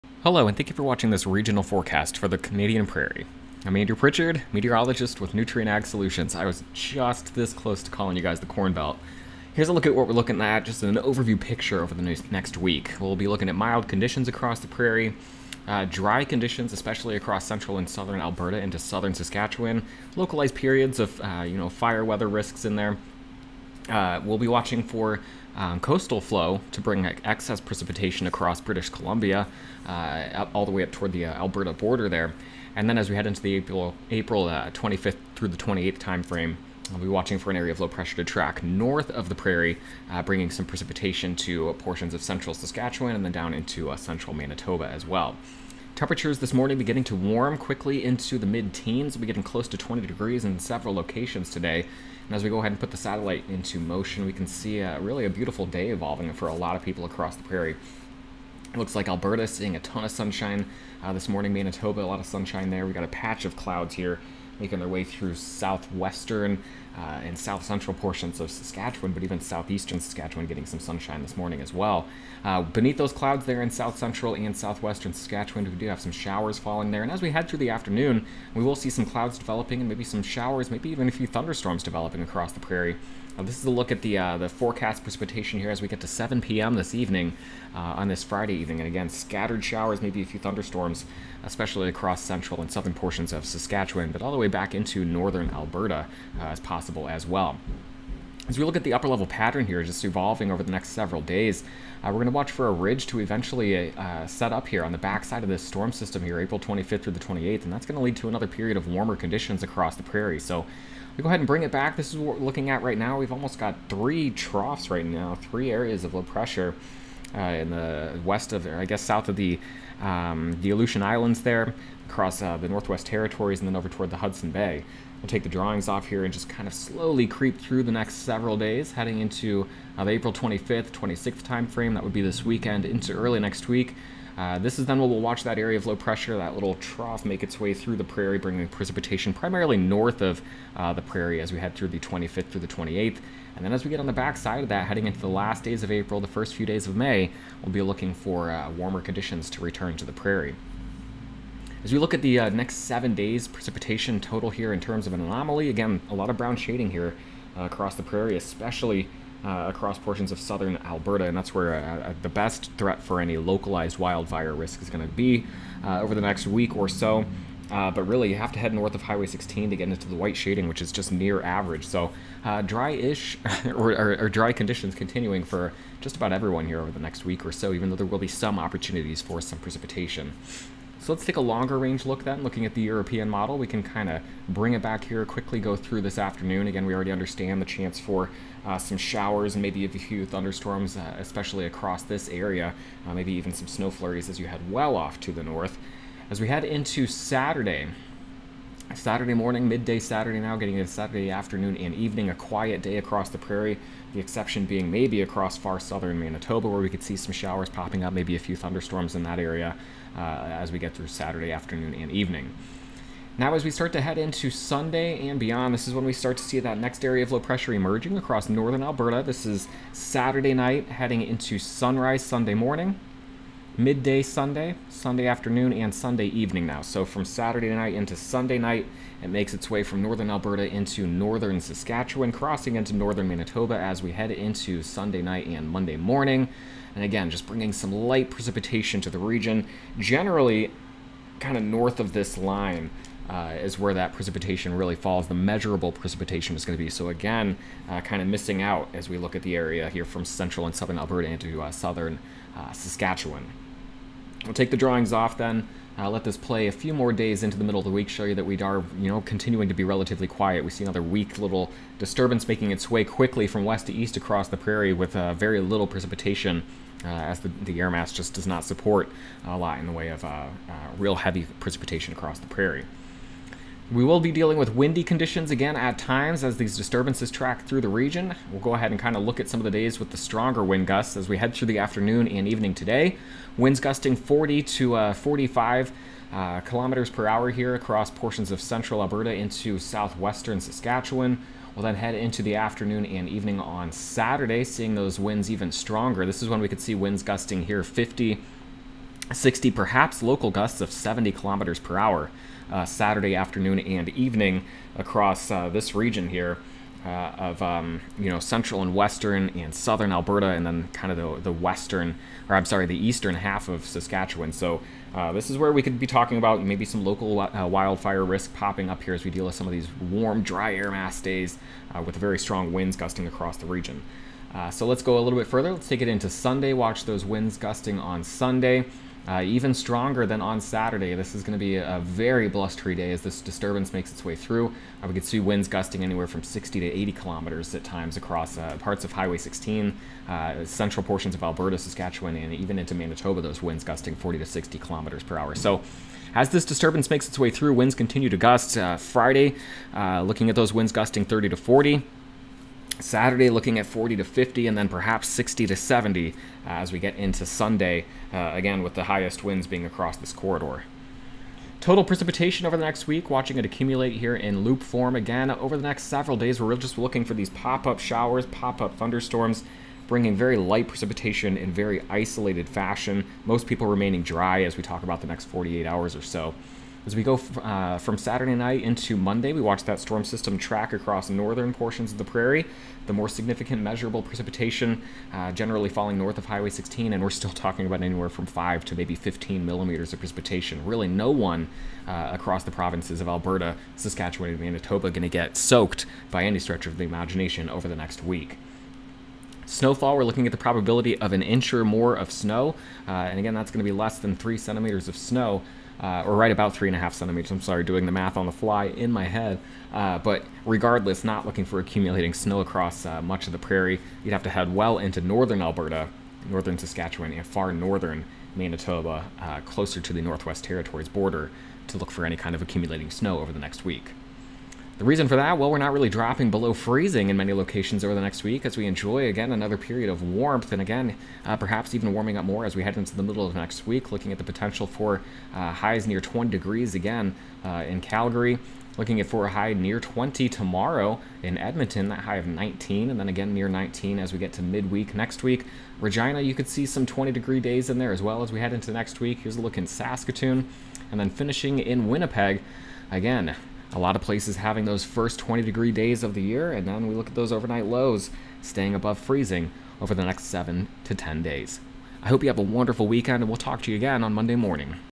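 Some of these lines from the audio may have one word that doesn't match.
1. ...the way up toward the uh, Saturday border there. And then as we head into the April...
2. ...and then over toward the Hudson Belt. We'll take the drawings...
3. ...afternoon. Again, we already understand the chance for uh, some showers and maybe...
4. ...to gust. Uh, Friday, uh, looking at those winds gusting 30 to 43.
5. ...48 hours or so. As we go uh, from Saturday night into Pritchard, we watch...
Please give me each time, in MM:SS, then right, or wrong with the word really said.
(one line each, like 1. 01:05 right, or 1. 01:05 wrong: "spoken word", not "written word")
1. 00:30 wrong: "Alberta", not "Saturday"
2. 02:03 wrong: "Bay", not "Belt"
3. 03:06 right
4. 05:48 wrong: "40", not "43"
5. 06:15 wrong: "Monday", not "Pritchard".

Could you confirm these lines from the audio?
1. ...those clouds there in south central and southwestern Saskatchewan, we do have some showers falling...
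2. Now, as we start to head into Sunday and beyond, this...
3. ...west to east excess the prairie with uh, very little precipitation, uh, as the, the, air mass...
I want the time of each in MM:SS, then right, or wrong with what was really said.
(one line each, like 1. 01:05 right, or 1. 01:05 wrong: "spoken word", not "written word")
1. 01:12 right
2. 03:33 right
3. 04:23 wrong: "across", not "excess".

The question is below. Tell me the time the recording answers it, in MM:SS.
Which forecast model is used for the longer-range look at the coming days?
03:02.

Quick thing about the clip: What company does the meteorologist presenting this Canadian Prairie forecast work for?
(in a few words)
Nutrien Ag Solutions.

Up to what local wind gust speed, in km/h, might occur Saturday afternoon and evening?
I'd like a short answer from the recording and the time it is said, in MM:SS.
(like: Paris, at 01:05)
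70 kilometers per hour, at 05:00.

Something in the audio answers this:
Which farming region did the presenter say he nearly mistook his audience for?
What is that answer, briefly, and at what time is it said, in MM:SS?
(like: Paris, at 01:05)
Corn Belt, at 00:08.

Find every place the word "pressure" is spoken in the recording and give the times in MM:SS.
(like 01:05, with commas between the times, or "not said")
00:37, 01:56, 02:15, 03:37.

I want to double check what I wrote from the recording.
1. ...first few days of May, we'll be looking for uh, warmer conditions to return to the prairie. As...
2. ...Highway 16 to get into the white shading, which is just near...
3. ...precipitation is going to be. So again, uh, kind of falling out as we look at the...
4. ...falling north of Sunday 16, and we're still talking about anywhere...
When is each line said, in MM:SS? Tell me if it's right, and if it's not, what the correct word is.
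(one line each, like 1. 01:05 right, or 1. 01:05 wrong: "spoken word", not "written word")
1. 02:26 right
2. 02:49 right
3. 04:05 wrong: "missing", not "falling"
4. 06:25 wrong: "Highway", not "Sunday".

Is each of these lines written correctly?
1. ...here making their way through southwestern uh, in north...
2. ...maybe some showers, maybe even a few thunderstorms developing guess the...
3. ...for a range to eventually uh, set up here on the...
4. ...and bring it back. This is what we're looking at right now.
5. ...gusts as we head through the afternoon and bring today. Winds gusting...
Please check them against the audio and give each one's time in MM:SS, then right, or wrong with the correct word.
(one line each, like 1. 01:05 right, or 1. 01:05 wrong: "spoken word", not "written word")
1. 01:03 wrong: "south", not "north"
2. 01:19 wrong: "across", not "guess"
3. 01:42 wrong: "ridge", not "range"
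4. 01:51 right
5. 04:40 wrong: "evening", not "bring".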